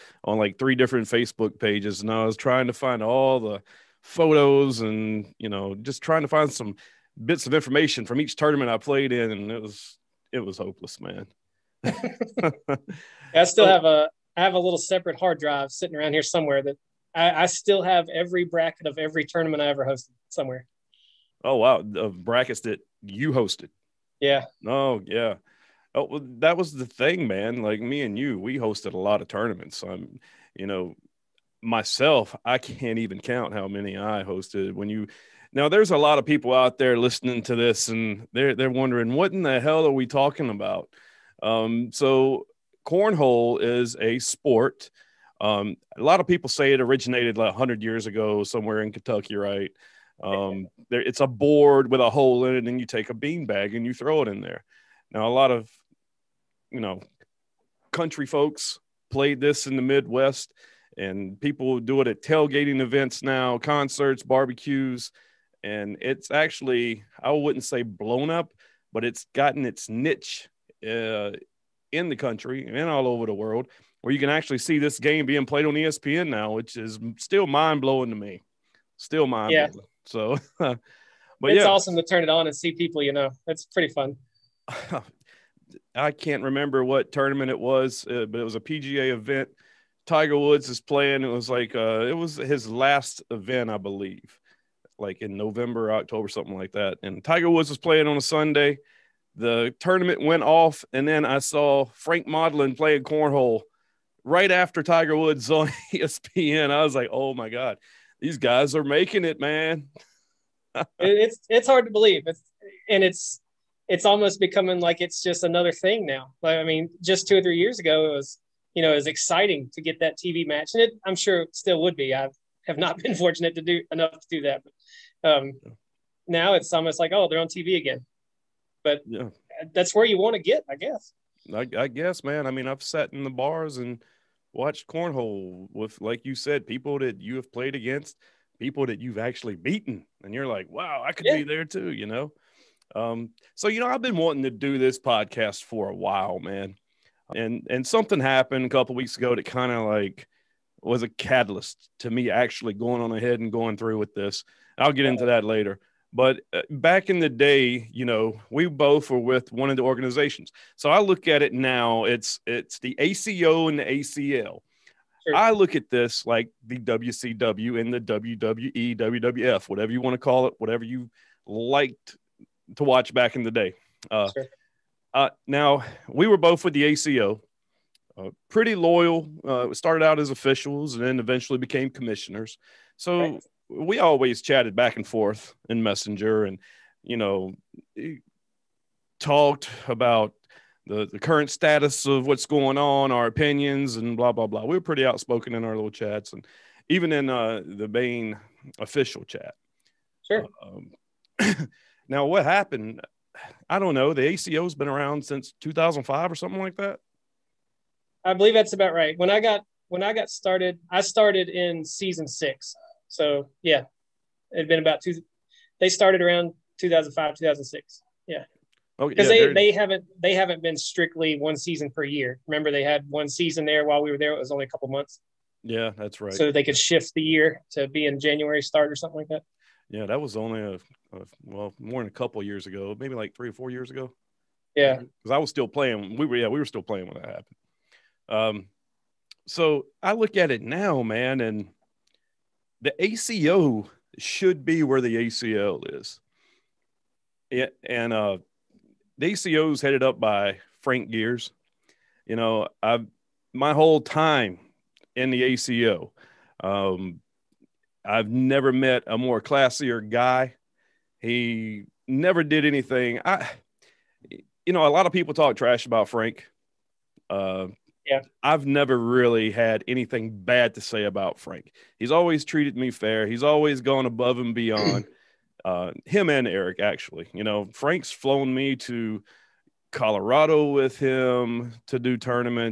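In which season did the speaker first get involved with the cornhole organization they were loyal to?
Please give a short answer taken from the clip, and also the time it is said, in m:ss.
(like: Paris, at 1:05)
season 6, at 3:31.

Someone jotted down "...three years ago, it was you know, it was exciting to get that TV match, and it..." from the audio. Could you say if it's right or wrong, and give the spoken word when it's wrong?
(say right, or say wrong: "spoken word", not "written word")
right.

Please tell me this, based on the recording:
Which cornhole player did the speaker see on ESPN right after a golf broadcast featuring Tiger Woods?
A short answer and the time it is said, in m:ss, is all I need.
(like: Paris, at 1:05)
Frank Modlin, at 1:41.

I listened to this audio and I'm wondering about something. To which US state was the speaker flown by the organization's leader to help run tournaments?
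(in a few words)
Colorado.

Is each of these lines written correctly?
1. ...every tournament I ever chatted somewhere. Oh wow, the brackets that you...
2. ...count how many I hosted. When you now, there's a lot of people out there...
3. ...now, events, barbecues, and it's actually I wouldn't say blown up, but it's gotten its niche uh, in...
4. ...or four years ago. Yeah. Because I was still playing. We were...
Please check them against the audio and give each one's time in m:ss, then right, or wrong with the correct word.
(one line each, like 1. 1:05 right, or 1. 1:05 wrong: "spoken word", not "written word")
1. 0:18 wrong: "hosted", not "chatted"
2. 0:33 right
3. 1:03 wrong: "concerts", not "events"
4. 3:53 right.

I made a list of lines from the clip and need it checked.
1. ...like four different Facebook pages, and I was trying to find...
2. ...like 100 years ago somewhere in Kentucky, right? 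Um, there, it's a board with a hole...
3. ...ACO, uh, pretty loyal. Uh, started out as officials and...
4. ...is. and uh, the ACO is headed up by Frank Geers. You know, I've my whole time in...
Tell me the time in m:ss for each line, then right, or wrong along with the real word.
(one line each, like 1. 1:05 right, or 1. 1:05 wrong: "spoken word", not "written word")
1. 0:00 wrong: "three", not "four"
2. 0:47 right
3. 2:56 right
4. 4:05 right.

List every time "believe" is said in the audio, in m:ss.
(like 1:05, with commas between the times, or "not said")
1:33, 1:51, 3:28.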